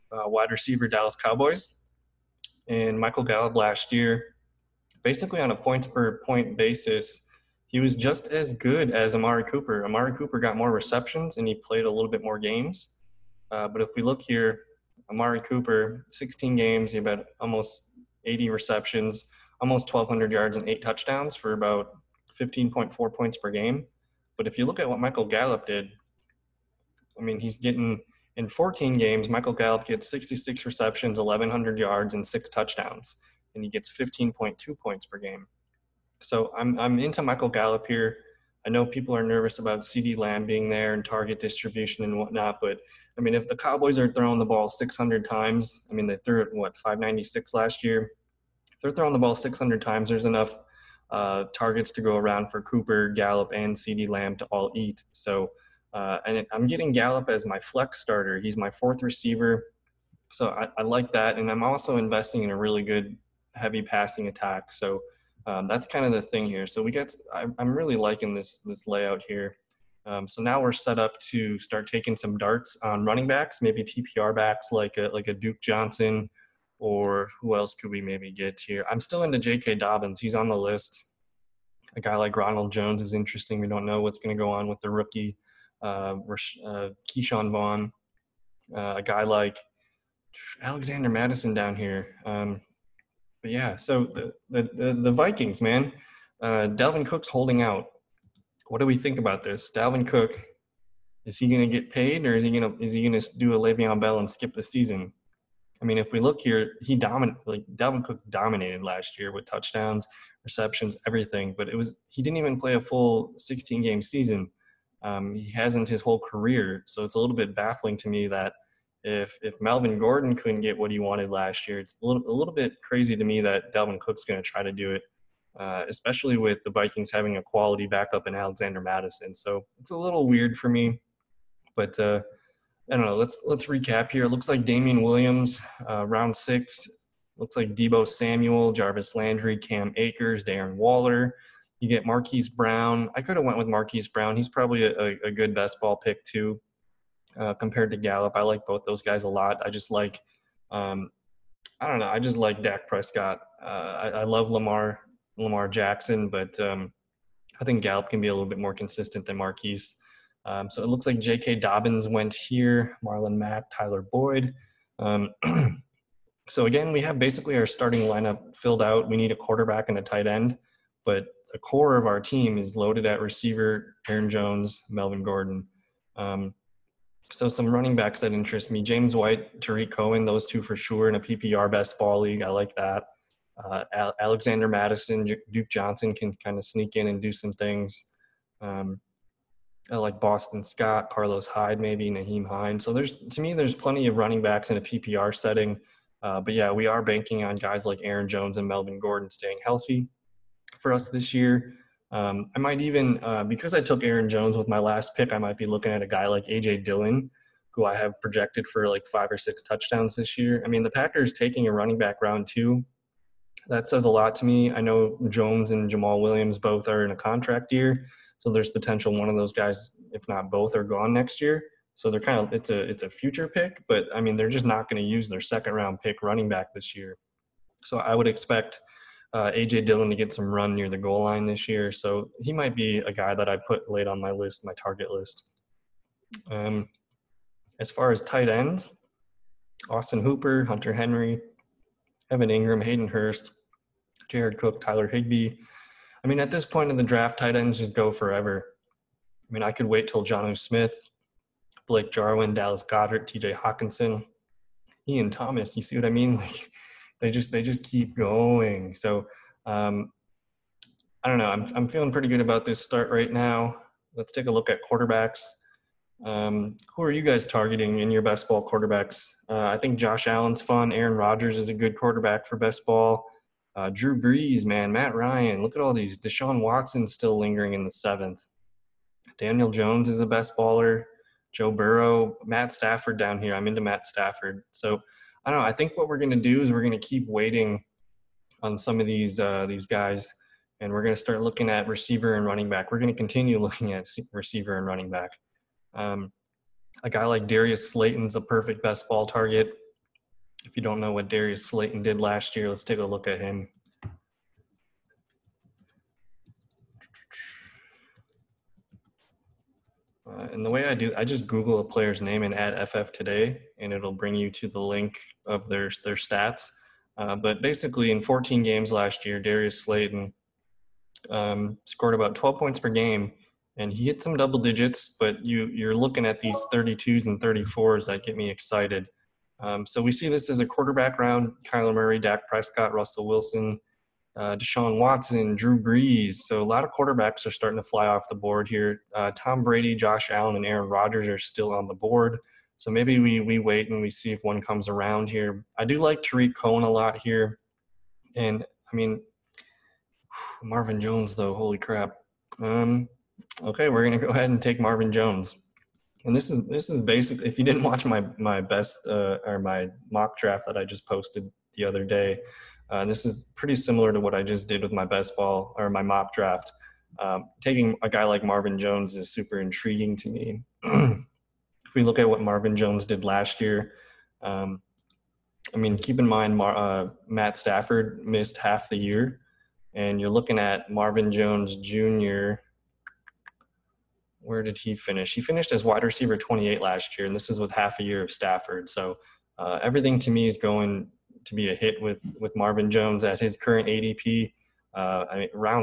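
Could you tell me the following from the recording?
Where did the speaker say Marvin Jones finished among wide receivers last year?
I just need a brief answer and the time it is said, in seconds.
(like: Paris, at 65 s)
wide receiver 28, at 385 s.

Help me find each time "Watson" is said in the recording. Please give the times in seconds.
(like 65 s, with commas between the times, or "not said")
276 s, 334 s.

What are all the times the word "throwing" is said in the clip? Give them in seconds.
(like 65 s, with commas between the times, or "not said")
44 s, 48 s.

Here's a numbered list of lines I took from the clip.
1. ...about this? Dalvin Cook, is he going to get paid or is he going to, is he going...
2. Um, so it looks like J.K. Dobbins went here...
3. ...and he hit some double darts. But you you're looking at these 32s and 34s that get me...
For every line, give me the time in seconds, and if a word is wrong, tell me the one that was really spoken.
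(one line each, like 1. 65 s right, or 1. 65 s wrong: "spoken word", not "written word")
1. 99 s right
2. 160 s right
3. 323 s wrong: "digits", not "darts".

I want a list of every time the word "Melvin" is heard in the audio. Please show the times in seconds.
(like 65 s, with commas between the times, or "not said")
119 s, 174 s, 198 s.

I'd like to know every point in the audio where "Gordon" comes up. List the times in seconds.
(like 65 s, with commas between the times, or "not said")
119 s, 175 s, 198 s.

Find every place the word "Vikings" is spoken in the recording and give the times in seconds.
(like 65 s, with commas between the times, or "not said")
95 s, 126 s.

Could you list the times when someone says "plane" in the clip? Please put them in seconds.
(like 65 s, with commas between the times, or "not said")
not said.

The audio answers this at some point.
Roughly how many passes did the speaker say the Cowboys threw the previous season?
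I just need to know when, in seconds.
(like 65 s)
46 s.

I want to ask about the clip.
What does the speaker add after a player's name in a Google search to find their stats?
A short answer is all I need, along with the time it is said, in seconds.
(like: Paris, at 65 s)
FF today, at 312 s.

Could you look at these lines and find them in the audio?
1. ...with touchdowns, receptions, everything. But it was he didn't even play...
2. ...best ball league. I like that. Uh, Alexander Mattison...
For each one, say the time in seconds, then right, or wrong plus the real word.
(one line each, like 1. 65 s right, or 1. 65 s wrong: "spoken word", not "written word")
1. 109 s right
2. 181 s right.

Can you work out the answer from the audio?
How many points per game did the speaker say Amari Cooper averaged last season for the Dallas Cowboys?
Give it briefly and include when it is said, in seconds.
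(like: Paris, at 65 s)
15.4, at 22 s.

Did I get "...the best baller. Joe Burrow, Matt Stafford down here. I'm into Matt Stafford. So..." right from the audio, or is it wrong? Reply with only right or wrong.
right.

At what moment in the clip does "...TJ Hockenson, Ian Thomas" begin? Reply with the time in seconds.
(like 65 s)
253 s.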